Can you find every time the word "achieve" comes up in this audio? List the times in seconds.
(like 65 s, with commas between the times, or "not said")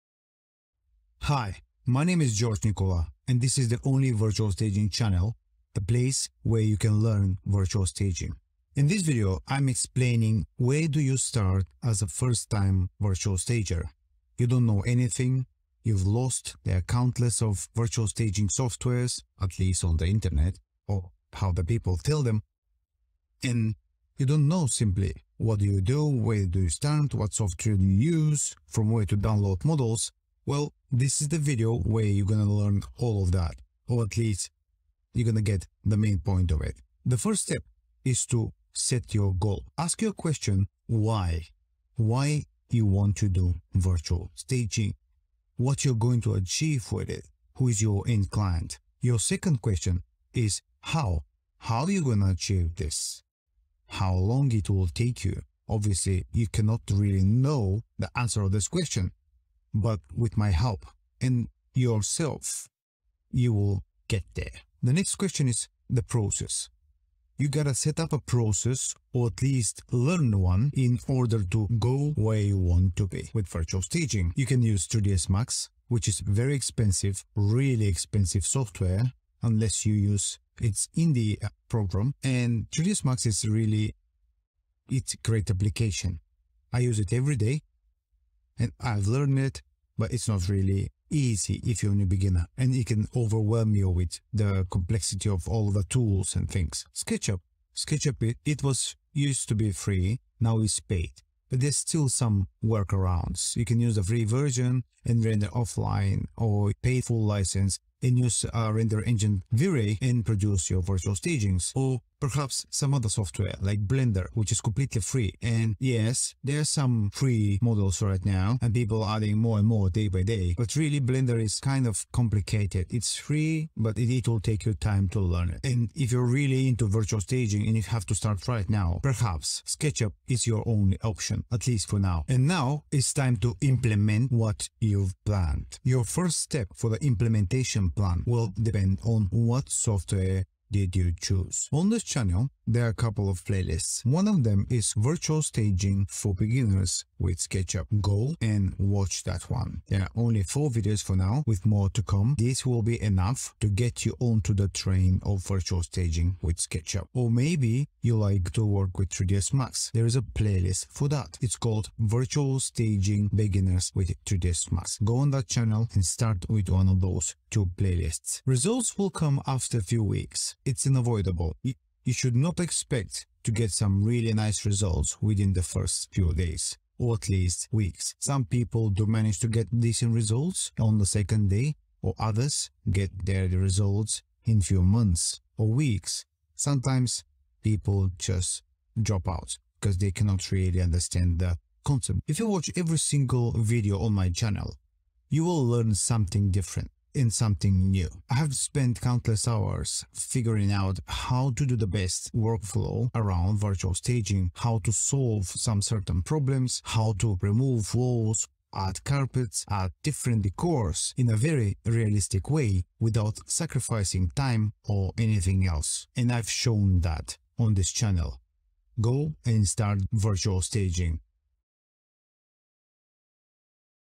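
46 s, 52 s.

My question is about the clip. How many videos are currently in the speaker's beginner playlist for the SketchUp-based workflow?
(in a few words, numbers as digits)
4.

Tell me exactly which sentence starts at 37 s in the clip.
The first step is to set your goal.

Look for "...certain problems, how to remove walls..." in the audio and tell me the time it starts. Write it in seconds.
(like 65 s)
205 s.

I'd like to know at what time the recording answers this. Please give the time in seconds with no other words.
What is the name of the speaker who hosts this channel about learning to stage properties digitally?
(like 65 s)
2 s.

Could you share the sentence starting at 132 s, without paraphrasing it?
And now it's time to implement what you've planned.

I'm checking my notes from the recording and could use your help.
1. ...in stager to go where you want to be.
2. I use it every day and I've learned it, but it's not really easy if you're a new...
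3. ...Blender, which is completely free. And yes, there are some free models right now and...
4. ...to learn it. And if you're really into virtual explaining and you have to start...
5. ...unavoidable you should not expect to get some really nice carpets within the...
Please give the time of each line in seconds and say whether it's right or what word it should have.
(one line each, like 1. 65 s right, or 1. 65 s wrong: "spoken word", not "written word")
1. 70 s wrong: "order", not "stager"
2. 86 s right
3. 113 s right
4. 125 s wrong: "staging", not "explaining"
5. 170 s wrong: "results", not "carpets".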